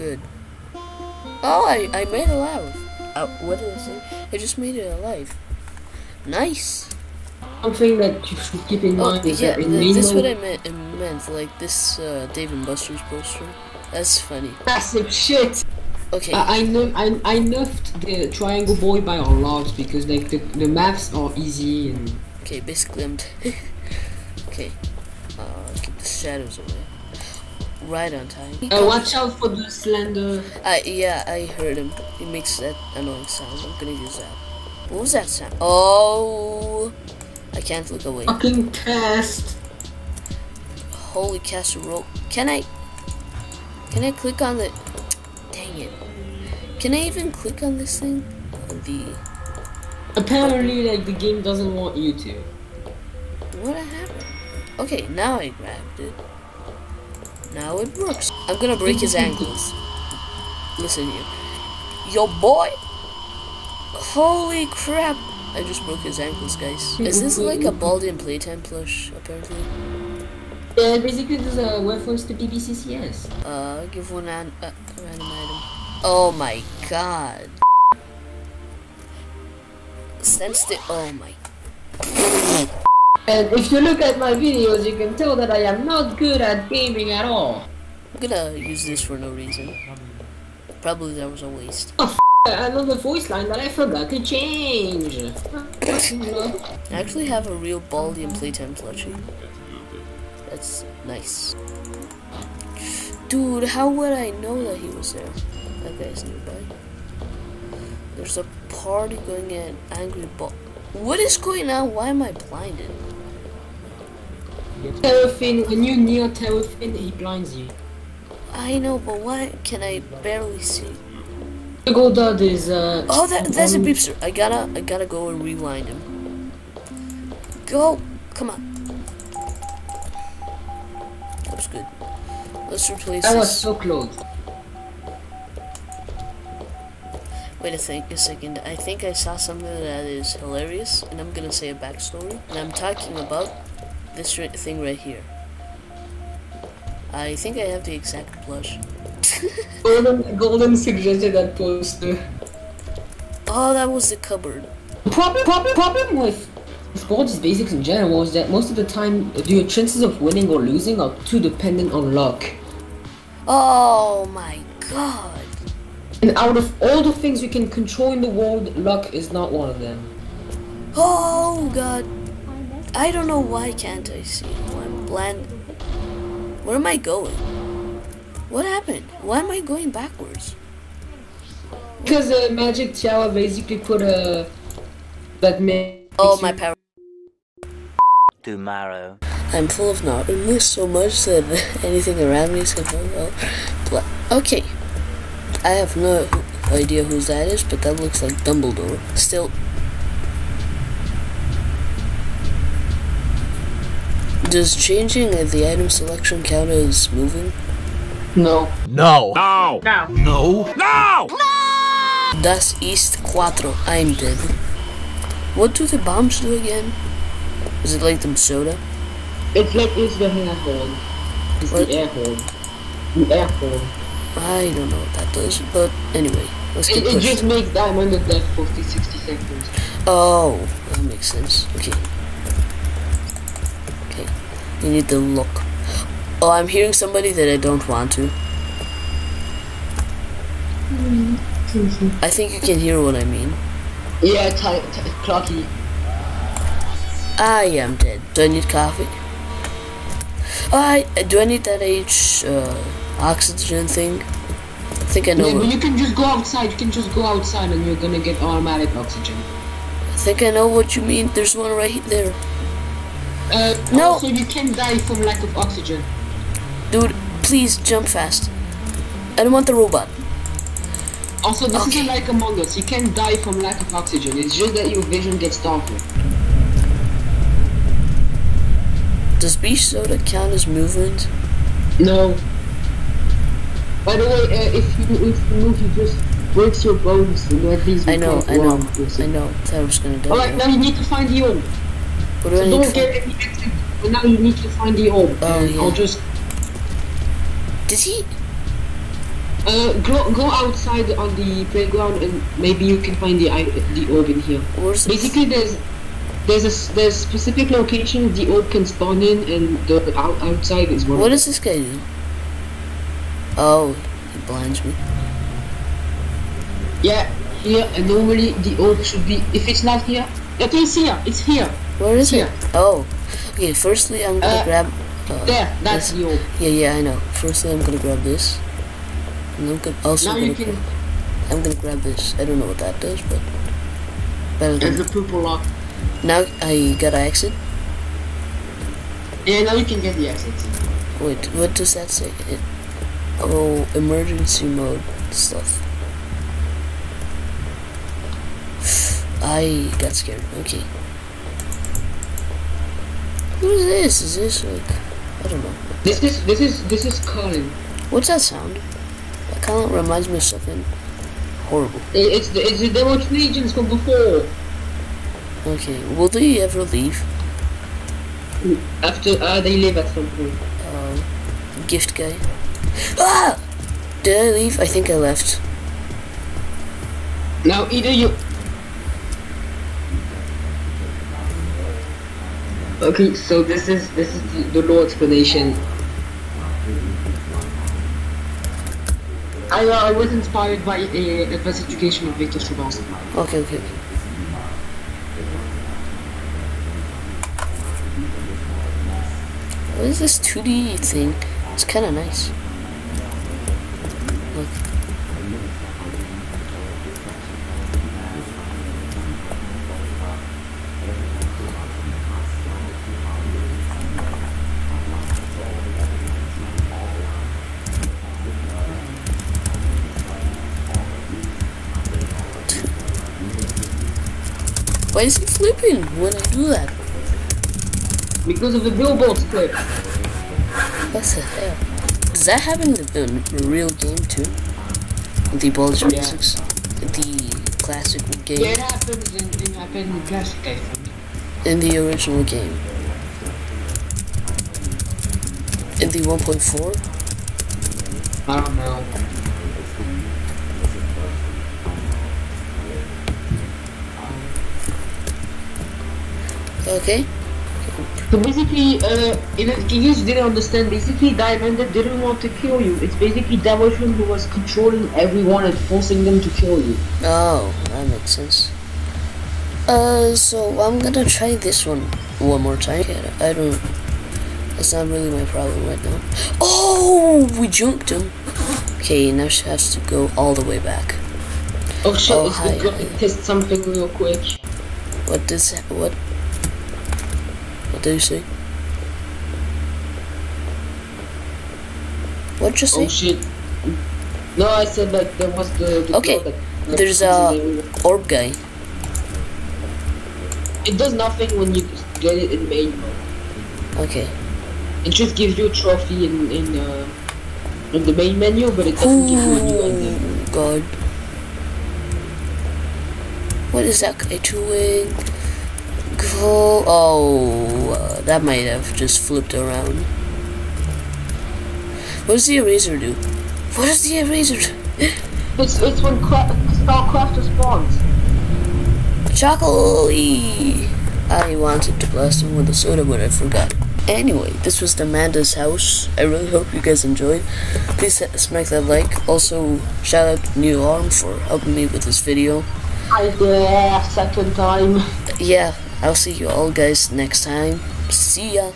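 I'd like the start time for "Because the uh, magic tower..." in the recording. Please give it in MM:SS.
03:02.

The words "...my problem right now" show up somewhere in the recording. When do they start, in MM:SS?
07:55.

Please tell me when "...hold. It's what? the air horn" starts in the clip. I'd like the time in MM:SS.
03:40.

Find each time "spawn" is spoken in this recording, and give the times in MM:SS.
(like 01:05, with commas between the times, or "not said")
05:08, 08:47.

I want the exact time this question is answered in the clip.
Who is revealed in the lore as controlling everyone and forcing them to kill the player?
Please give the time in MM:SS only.
07:43.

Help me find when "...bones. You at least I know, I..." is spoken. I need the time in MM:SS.
04:46.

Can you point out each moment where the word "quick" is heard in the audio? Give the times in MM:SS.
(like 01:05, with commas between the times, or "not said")
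08:04.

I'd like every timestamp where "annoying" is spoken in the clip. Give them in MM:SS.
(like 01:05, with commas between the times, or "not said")
00:32.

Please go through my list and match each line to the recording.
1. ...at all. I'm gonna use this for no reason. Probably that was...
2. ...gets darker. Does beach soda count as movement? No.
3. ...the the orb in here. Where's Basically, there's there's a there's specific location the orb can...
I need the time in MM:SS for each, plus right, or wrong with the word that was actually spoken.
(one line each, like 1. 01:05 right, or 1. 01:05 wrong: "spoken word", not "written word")
1. 01:27 right
2. 04:35 right
3. 05:03 right.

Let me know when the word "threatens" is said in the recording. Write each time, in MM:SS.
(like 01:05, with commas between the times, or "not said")
not said.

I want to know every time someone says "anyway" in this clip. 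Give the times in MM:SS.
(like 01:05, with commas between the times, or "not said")
03:46, 08:54.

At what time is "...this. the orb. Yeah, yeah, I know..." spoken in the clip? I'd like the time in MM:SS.
05:26.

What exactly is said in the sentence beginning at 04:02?
I think you can hear what I mean.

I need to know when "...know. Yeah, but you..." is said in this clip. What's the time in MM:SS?
04:15.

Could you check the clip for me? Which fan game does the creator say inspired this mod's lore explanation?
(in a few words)
Advanced Education of Victor Strauss.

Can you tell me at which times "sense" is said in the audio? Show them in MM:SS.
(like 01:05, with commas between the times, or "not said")
01:20, 03:51, 07:48.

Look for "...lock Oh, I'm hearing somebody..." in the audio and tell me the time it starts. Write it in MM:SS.
03:55.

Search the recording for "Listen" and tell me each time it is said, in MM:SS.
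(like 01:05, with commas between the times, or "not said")
01:00.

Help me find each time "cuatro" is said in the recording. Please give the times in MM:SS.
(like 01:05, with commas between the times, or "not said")
03:33.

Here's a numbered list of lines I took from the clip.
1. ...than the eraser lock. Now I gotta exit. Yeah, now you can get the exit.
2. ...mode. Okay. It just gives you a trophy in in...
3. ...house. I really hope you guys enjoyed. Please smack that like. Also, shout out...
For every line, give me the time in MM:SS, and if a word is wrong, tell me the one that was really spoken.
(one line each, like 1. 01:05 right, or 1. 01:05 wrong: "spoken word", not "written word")
1. 05:34 wrong: "pooper", not "eraser"
2. 08:23 right
3. 08:55 right.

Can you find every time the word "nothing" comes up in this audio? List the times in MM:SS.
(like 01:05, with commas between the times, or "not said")
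08:21.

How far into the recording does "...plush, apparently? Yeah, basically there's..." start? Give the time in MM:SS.
01:08.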